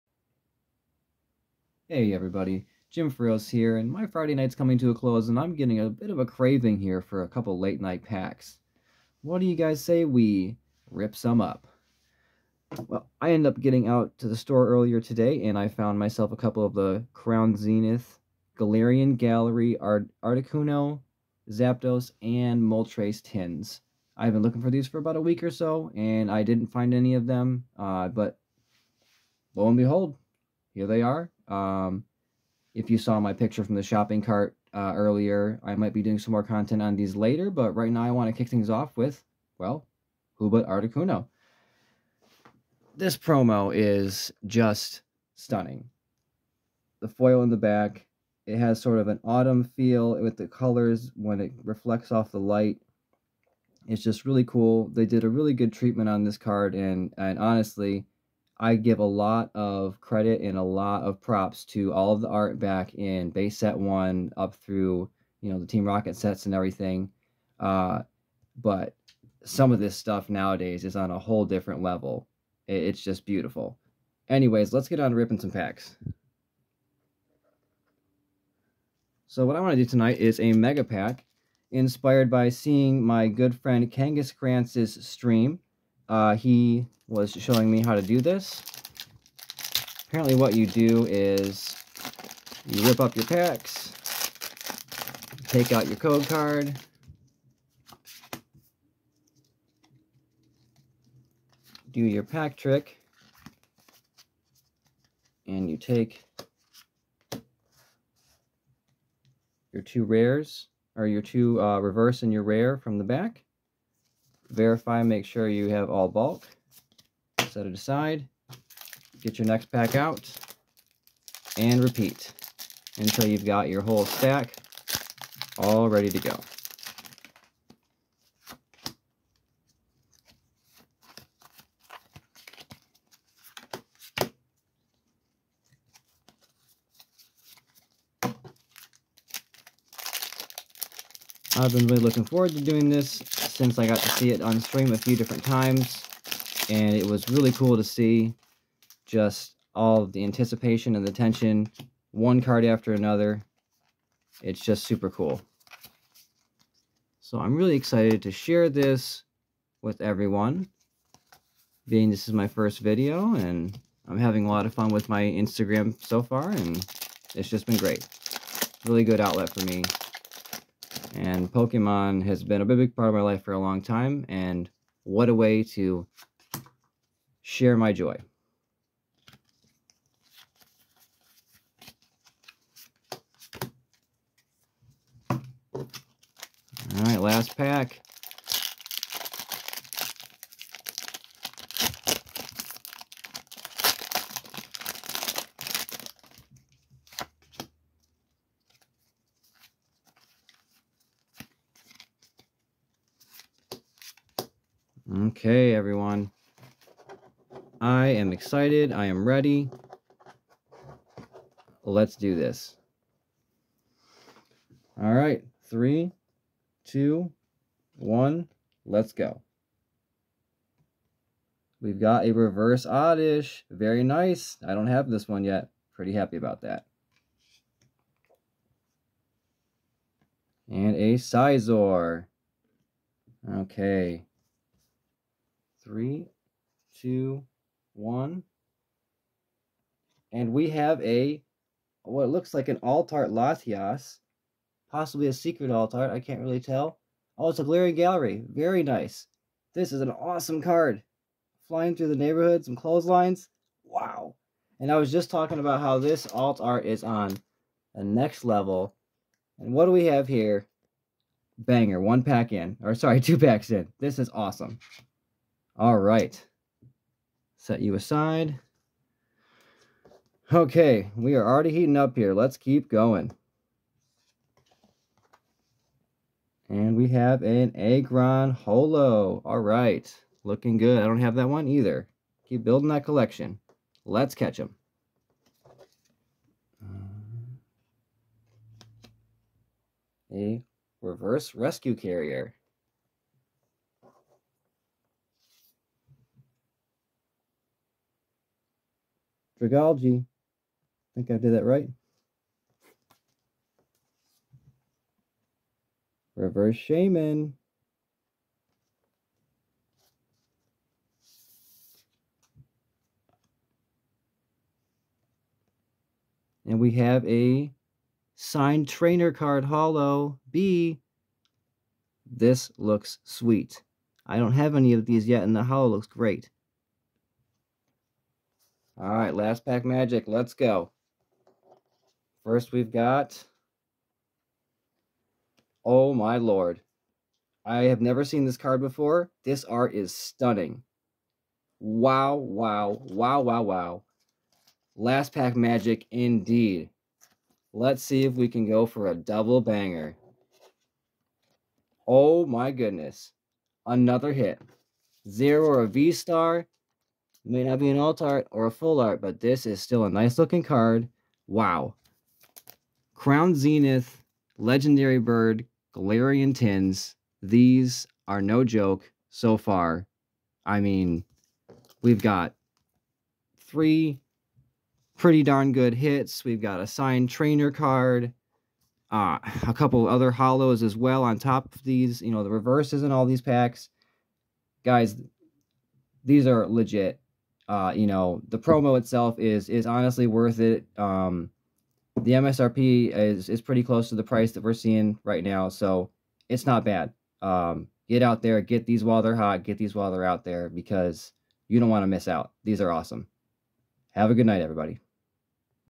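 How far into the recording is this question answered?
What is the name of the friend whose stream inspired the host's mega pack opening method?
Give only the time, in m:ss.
1:24.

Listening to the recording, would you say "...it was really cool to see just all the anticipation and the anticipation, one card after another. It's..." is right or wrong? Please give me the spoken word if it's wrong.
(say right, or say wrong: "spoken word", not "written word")
wrong: "tension", not "anticipation".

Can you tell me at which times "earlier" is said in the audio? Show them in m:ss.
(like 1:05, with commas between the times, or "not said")
0:14, 0:34.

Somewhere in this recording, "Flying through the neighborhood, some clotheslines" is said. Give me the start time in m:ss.
4:11.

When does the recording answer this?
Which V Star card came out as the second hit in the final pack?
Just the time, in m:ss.
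5:55.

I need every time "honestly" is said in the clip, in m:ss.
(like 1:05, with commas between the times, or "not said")
0:57, 6:29.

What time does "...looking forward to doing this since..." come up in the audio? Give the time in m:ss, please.
2:22.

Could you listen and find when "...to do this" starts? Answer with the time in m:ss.
1:27.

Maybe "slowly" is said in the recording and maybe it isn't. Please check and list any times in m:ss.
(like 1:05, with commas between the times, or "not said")
not said.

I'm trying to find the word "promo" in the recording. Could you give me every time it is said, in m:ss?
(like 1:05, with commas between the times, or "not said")
0:43, 6:28.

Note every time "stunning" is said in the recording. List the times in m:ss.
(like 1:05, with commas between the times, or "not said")
0:45, 5:40.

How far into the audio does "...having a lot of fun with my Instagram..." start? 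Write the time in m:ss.
2:44.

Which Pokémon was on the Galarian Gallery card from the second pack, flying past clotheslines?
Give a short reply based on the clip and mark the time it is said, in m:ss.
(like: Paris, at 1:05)
Latias, at 4:03.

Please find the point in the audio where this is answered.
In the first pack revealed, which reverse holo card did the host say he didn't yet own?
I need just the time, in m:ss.
3:42.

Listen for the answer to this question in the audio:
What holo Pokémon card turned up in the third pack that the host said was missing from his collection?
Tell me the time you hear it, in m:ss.
4:37.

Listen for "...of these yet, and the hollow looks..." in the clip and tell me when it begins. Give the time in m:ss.
5:24.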